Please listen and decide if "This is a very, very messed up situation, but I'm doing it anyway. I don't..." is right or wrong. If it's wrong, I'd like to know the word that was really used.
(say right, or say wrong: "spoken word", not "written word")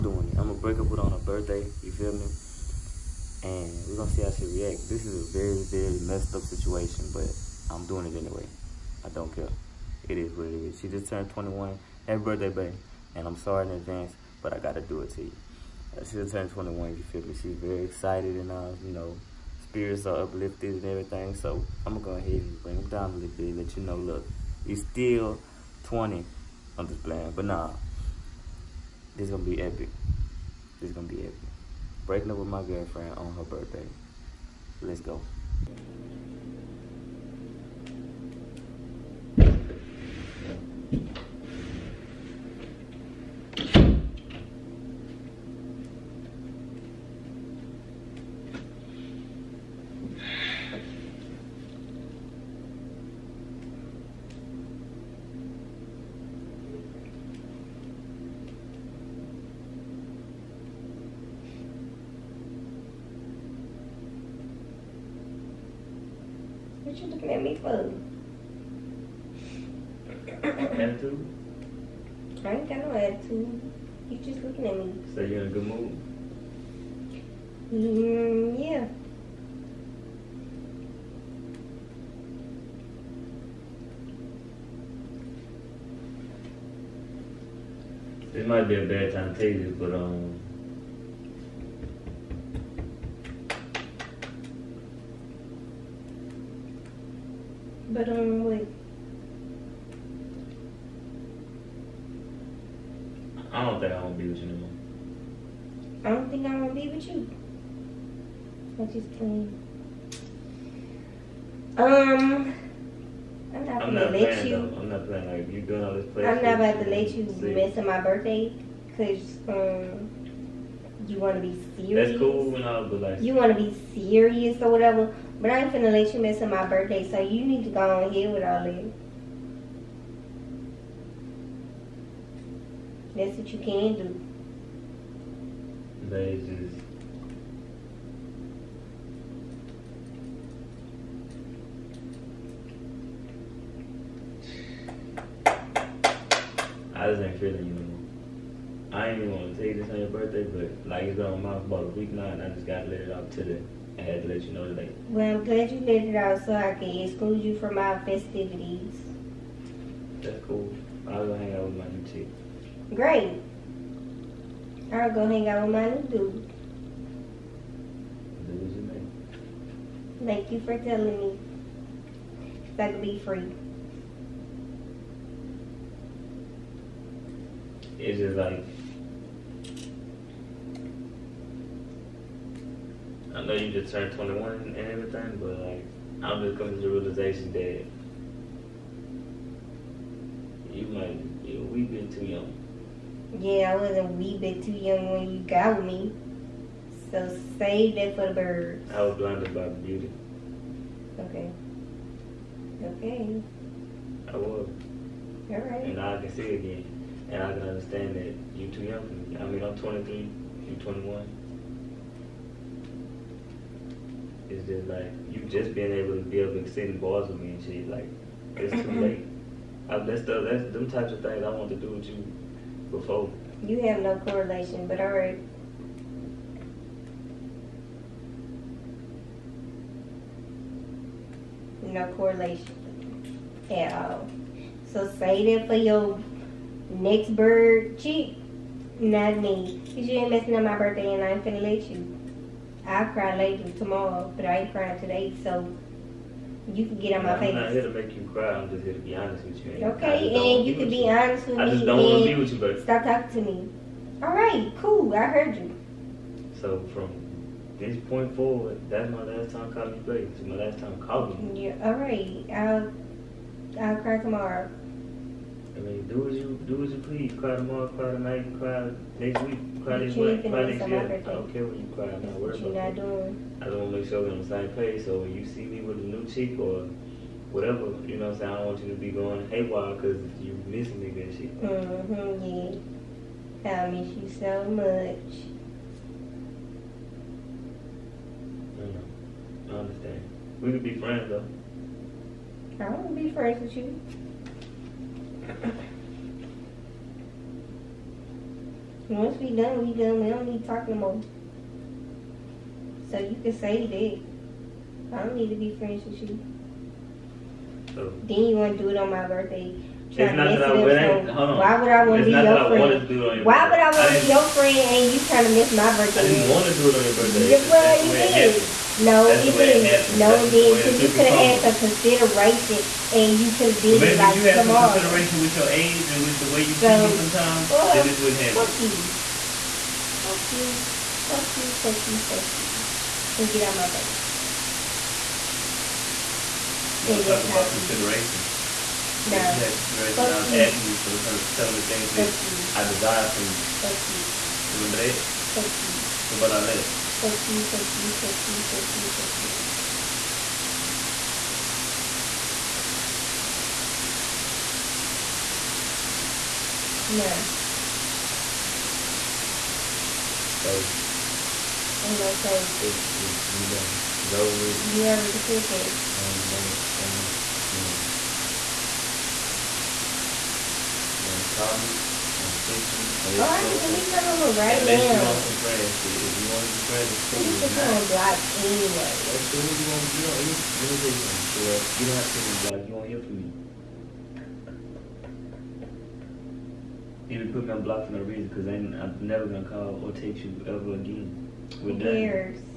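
right.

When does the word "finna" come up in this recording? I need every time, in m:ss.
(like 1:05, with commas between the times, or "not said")
2:05, 4:01.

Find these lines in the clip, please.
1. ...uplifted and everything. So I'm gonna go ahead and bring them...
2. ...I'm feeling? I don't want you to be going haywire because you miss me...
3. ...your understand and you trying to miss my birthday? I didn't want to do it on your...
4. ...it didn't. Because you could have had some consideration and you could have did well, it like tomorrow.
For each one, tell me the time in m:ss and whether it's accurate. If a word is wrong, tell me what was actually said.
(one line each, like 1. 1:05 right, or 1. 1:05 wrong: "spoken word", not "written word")
1. 0:20 right
2. 4:38 wrong: "saying", not "feeling"
3. 5:14 wrong: "friend", not "understand"
4. 5:20 right.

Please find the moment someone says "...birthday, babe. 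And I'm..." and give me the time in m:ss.
0:12.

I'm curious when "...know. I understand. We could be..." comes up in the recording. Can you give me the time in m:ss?
4:48.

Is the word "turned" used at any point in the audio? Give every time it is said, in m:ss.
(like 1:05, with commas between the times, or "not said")
0:11, 0:16, 3:03.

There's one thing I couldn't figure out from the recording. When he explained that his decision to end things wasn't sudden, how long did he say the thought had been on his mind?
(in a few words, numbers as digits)
about a week.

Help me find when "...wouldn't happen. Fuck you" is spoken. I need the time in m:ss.
5:28.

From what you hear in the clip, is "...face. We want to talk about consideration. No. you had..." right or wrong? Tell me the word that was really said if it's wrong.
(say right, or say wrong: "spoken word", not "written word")
right.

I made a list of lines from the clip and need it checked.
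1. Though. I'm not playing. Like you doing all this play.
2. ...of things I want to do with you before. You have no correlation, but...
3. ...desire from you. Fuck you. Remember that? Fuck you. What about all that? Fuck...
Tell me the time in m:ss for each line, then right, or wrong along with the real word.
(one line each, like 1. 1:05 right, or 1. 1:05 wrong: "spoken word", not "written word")
1. 1:54 right
2. 3:41 right
3. 5:42 right.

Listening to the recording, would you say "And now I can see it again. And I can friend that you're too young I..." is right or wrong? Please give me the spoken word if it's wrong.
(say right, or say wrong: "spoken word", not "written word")
wrong: "understand", not "friend".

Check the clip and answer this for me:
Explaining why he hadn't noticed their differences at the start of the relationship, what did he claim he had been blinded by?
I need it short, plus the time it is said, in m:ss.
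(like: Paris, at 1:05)
beauty, at 3:19.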